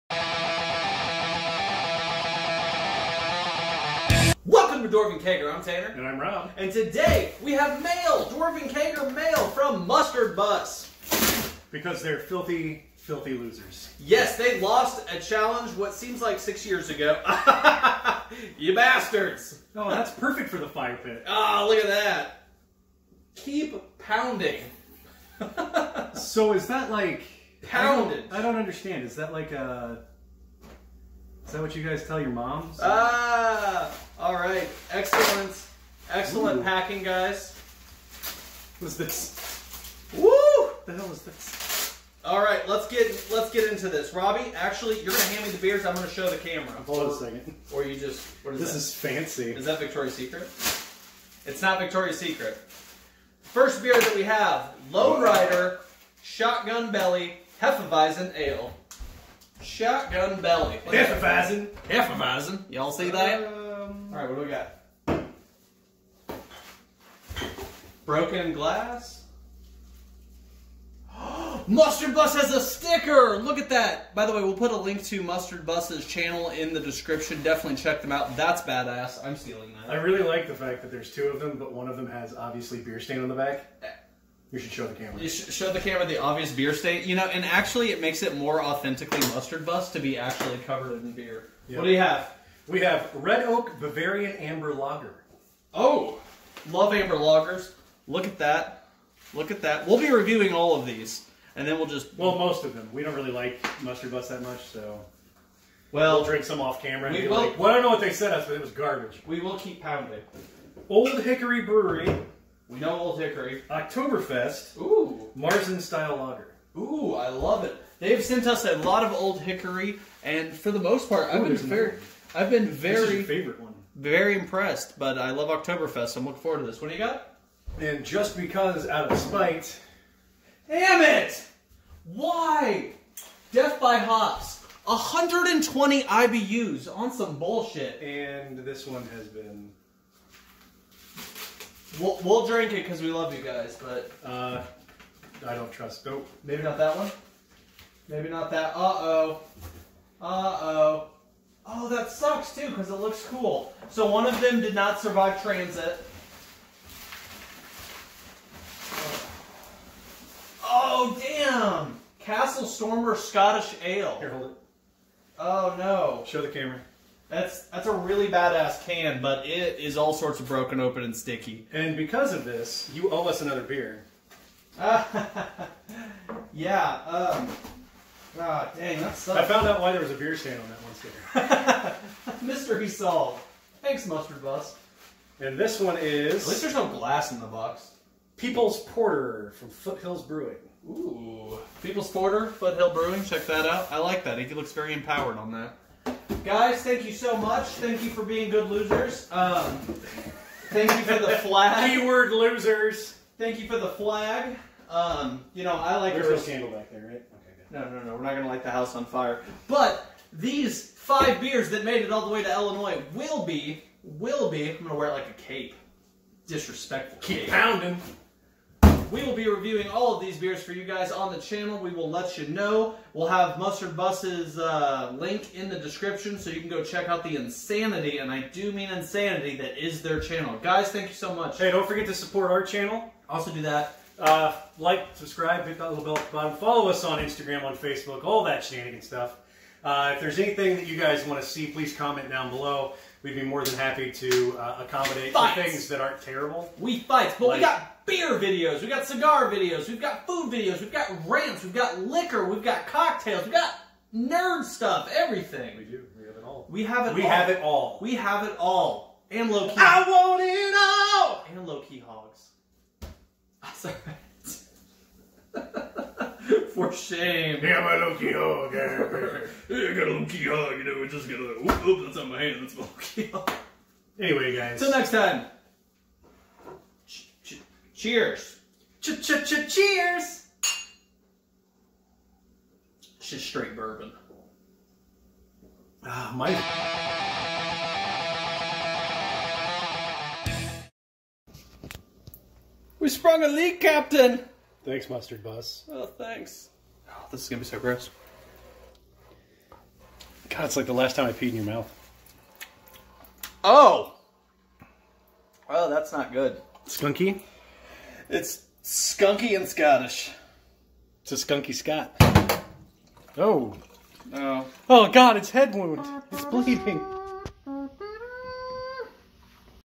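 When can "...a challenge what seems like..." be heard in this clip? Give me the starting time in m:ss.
0:15.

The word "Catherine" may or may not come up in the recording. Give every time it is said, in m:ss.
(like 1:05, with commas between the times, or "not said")
not said.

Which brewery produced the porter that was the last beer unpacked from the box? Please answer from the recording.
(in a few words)
Foothills Brewing.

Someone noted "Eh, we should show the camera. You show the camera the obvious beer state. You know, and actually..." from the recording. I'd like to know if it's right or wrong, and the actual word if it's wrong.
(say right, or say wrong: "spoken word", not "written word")
right.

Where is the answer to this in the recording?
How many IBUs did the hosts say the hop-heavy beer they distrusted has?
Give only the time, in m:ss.
2:14.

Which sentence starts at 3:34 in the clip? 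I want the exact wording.
I'm gonna wear it like a cape.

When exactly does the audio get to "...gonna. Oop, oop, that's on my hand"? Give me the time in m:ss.
4:31.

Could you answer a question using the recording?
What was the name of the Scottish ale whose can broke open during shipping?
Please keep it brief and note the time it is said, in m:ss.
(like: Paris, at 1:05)
Castle Stormer, at 2:42.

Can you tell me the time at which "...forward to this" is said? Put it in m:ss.
2:06.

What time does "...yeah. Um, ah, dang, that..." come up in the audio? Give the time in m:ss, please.
2:56.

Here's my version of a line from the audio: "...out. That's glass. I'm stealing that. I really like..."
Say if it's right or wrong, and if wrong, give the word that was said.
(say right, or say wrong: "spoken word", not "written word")
wrong: "badass", not "glass".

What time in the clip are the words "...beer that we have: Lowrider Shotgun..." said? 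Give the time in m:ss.
0:53.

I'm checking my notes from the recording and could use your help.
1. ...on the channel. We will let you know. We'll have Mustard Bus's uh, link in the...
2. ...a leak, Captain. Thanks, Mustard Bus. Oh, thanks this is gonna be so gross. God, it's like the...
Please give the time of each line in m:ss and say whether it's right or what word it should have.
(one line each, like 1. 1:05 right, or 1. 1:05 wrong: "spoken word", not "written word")
1. 3:41 right
2. 4:53 right.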